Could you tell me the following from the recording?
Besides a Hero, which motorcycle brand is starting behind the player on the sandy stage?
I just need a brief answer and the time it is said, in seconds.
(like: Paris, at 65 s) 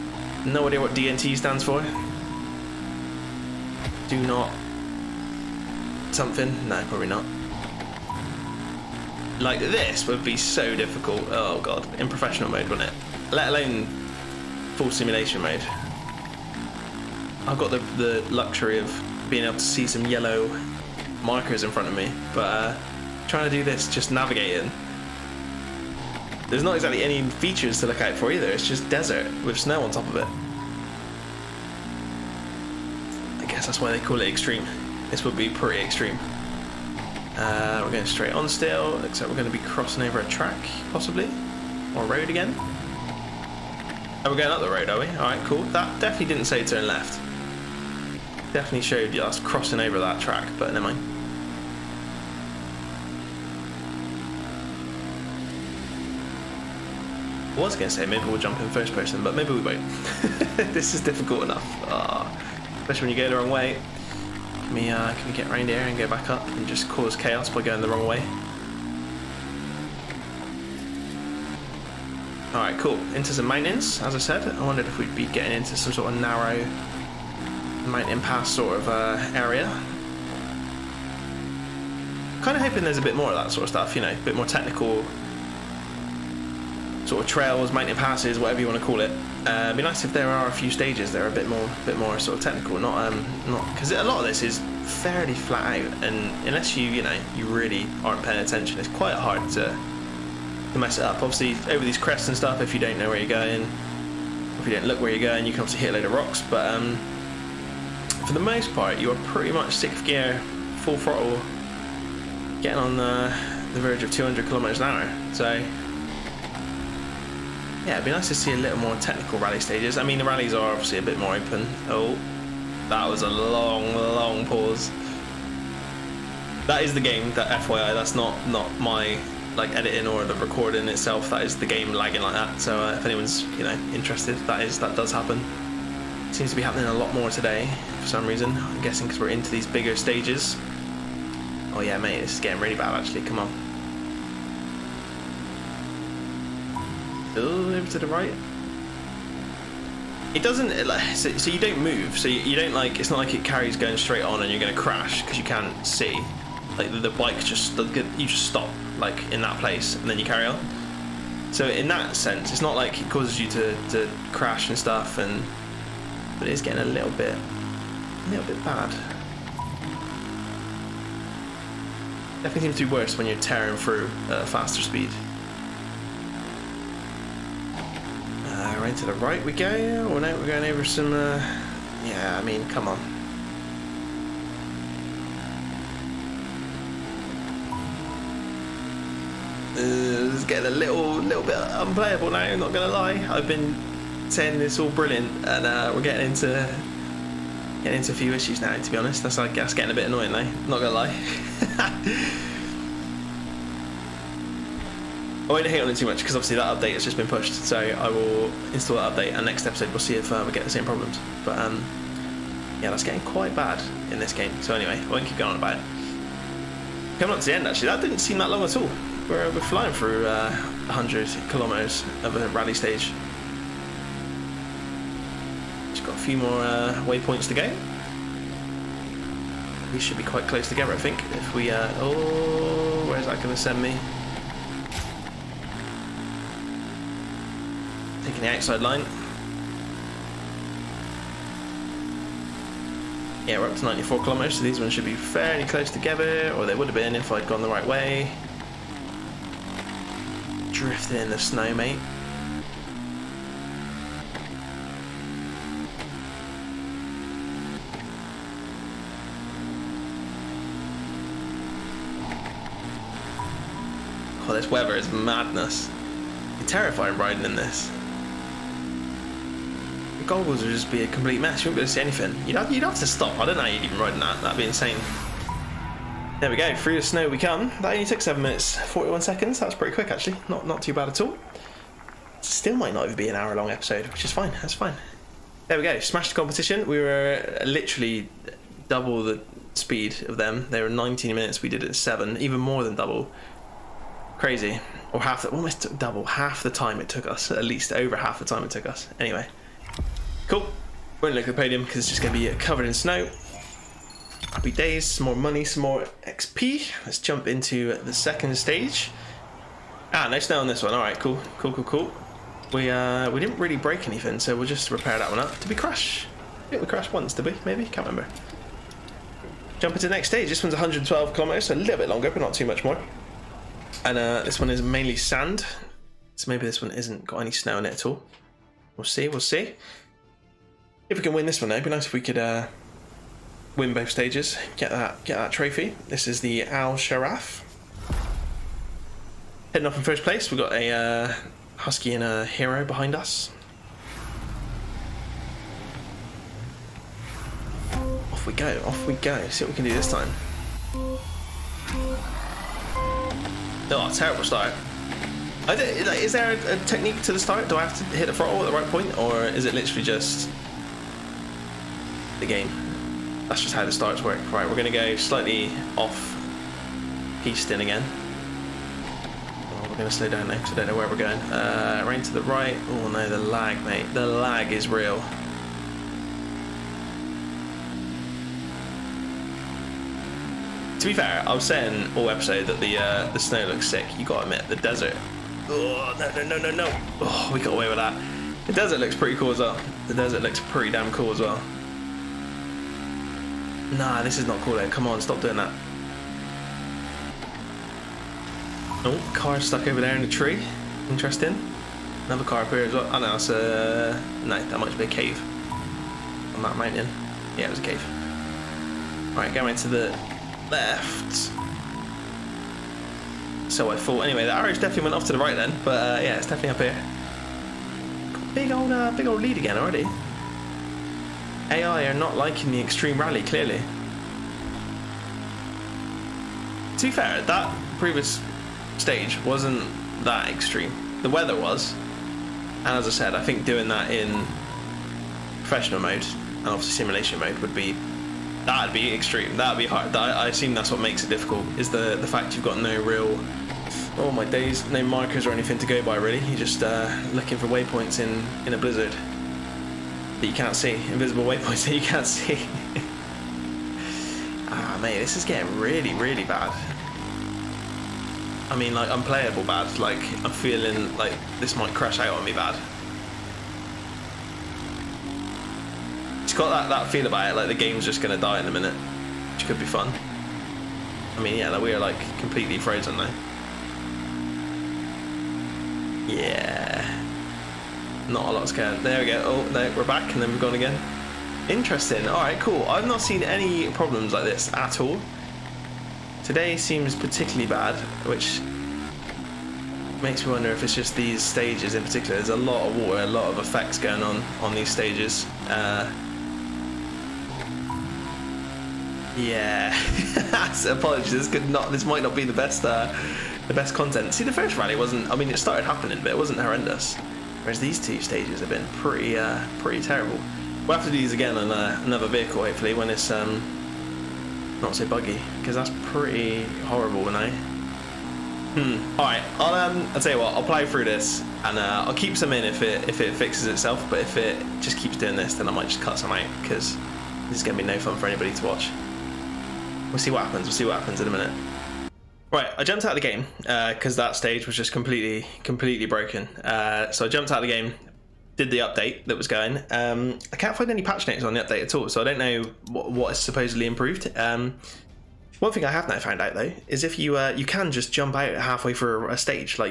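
Husky, at 341 s.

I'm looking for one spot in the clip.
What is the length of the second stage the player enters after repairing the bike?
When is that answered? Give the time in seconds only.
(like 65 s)
320 s.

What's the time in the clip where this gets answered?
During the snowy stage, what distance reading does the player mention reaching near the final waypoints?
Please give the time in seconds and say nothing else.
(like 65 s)
243 s.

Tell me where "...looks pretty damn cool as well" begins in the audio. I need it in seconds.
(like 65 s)
390 s.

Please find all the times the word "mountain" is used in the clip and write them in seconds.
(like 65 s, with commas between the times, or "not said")
73 s, 77 s, 87 s, 406 s.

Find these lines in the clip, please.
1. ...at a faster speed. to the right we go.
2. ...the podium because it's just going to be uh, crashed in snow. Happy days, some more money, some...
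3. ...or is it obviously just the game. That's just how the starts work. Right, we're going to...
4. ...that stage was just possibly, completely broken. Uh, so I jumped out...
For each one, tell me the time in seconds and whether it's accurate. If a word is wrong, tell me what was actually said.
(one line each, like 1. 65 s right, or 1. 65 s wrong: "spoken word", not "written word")
1. 174 s right
2. 301 s wrong: "covered", not "crashed"
3. 359 s wrong: "literally", not "obviously"
4. 534 s wrong: "completely", not "possibly".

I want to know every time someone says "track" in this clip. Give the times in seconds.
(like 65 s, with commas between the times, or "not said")
40 s, 50 s.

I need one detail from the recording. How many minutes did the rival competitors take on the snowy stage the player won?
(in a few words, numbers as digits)
19.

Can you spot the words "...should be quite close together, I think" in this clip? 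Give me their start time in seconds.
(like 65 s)
229 s.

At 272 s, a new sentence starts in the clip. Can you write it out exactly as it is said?
You'd have, you'd have to stop.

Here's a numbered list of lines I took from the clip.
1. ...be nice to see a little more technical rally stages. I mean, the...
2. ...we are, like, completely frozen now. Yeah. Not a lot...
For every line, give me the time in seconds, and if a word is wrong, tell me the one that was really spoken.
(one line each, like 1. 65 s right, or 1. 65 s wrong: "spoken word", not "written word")
1. 118 s right
2. 471 s right.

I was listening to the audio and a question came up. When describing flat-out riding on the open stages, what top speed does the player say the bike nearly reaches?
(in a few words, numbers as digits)
200 kilometers an hour.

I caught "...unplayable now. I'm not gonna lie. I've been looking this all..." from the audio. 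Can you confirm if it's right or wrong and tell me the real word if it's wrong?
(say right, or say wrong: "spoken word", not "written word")
wrong: "saying", not "looking".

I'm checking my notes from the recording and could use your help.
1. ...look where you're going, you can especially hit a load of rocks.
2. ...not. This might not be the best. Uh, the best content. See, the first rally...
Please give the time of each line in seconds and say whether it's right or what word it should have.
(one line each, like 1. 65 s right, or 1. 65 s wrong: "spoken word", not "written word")
1. 104 s wrong: "obviously", not "especially"
2. 501 s right.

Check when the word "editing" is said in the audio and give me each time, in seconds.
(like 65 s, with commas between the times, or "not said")
129 s.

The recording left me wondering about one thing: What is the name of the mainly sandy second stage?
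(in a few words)
Al Sharaf.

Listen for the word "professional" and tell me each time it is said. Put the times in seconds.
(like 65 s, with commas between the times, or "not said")
12 s, 435 s.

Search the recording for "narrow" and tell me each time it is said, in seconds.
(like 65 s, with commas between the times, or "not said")
76 s.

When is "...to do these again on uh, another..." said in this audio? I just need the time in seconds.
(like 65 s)
511 s.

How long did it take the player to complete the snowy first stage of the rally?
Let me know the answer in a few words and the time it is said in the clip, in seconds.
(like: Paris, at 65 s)
7 minutes 41 seconds, at 278 s.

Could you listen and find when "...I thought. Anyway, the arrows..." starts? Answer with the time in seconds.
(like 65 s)
413 s.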